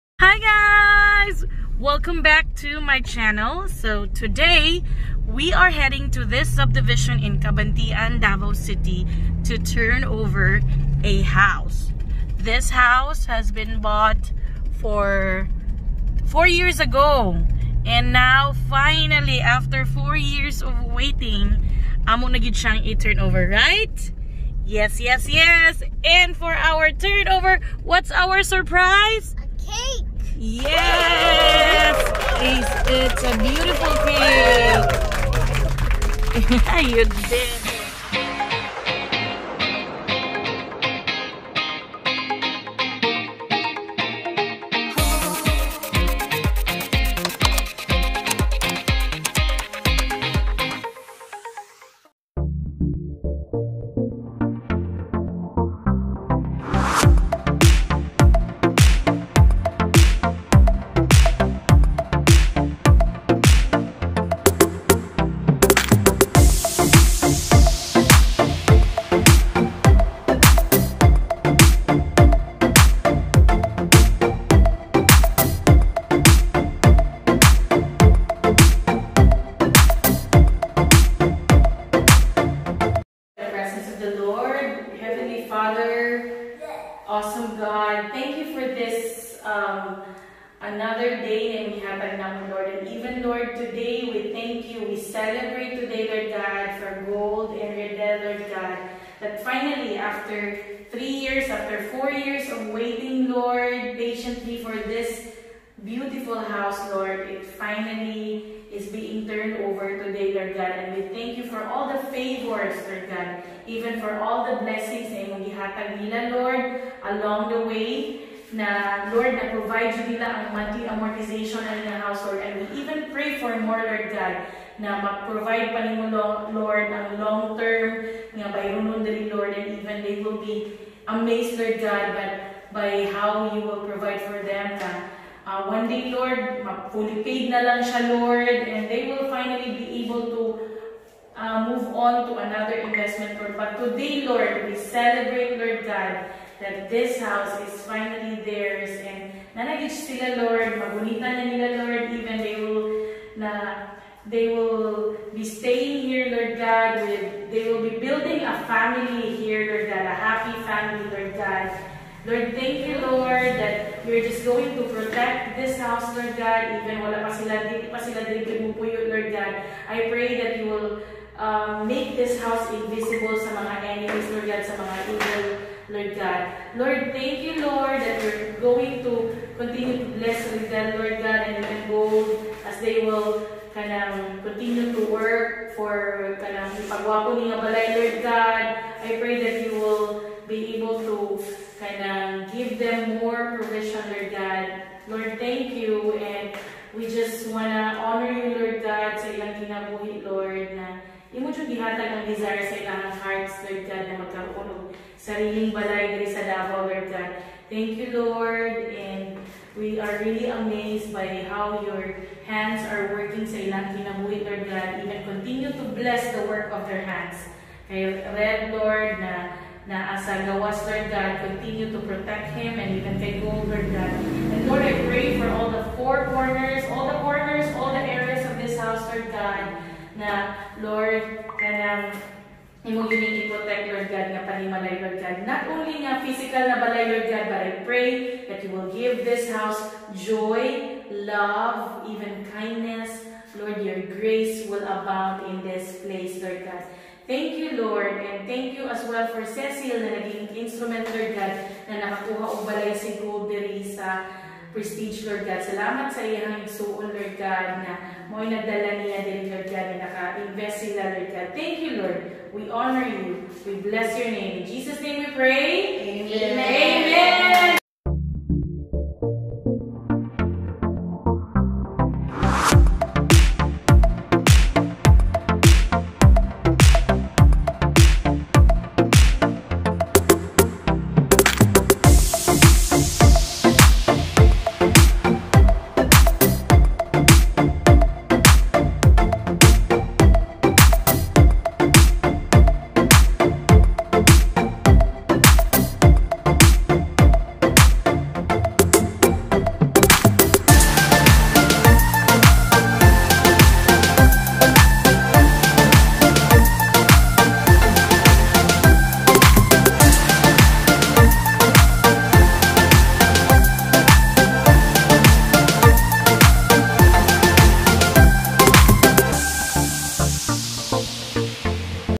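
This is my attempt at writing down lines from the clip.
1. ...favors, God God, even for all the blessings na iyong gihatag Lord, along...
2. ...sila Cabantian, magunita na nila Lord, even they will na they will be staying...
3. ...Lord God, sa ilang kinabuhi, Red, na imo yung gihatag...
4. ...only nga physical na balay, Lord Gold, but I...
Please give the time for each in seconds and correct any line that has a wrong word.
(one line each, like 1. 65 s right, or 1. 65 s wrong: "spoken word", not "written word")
1. 112 s wrong: "Lord", not "God"
2. 149 s wrong: "Lord", not "Cabantian"
3. 198 s wrong: "Lord", not "Red"
4. 235 s wrong: "God", not "Gold".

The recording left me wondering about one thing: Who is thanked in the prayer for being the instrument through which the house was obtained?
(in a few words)
Cecil.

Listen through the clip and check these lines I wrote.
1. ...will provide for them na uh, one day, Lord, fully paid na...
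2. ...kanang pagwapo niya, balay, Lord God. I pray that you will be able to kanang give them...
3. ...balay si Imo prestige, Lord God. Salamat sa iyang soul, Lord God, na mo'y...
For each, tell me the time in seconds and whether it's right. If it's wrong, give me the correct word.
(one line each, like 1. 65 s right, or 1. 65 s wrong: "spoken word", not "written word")
1. 133 s right
2. 186 s right
3. 252 s wrong: "Gold", not "Imo".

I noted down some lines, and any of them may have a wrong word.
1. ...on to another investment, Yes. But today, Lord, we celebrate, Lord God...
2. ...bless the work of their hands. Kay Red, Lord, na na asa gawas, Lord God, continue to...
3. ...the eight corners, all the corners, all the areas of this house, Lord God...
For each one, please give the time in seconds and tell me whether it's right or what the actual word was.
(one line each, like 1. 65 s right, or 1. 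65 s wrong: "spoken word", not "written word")
1. 141 s wrong: "Lord", not "Yes"
2. 215 s right
3. 225 s wrong: "four", not "eight".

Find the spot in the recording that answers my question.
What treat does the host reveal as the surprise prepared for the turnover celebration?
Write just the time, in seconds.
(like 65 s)
29 s.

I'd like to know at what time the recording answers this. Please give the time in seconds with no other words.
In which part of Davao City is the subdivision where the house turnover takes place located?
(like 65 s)
7 s.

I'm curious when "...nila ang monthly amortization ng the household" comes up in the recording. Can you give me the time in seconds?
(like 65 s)
120 s.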